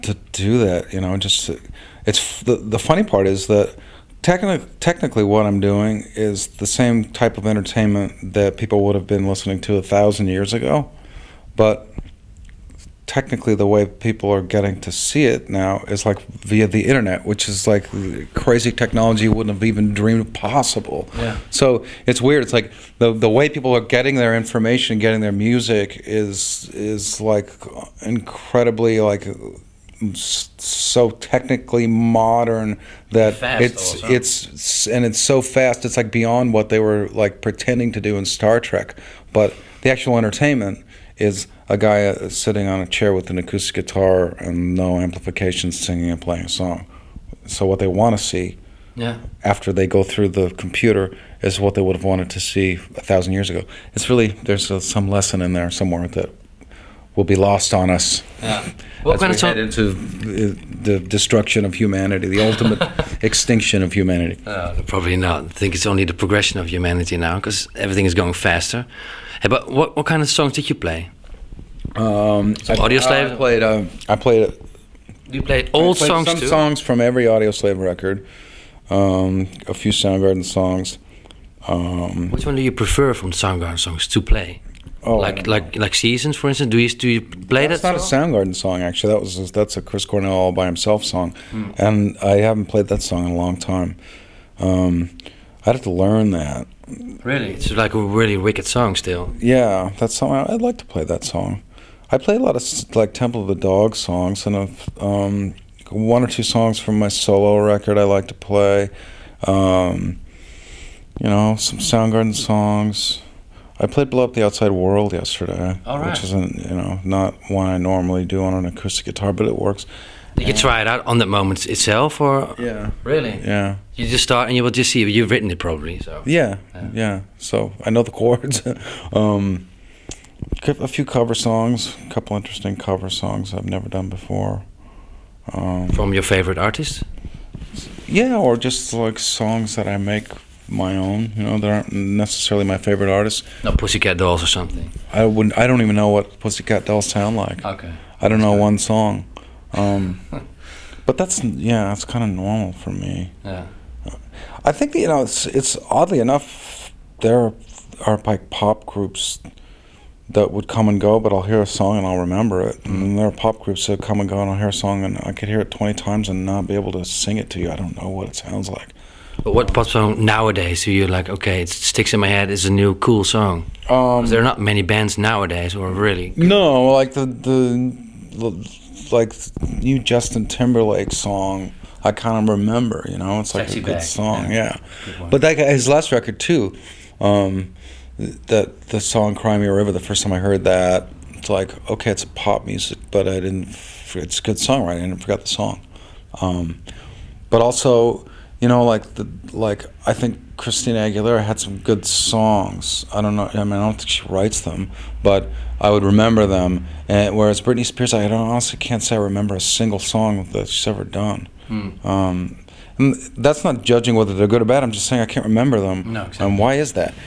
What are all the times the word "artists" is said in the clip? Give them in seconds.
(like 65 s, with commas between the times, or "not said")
136 s, 143 s.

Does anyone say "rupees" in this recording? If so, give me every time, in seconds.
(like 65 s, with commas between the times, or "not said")
not said.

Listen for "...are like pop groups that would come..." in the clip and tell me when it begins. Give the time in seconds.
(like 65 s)
158 s.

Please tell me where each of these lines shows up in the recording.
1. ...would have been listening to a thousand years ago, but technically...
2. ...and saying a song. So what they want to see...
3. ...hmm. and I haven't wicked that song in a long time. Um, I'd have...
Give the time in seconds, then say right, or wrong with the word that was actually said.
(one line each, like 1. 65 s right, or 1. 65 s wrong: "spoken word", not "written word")
1. 8 s right
2. 46 s wrong: "playing", not "saying"
3. 91 s wrong: "played", not "wicked".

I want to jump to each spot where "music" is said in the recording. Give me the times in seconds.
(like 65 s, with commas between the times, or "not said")
25 s, 192 s.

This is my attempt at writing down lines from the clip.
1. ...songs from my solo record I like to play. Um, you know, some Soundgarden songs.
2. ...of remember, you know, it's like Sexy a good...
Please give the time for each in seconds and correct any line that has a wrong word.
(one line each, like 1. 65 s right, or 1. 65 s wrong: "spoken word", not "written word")
1. 106 s right
2. 182 s right.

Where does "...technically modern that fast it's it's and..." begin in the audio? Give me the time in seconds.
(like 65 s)
31 s.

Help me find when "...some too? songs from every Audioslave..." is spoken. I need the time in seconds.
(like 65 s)
76 s.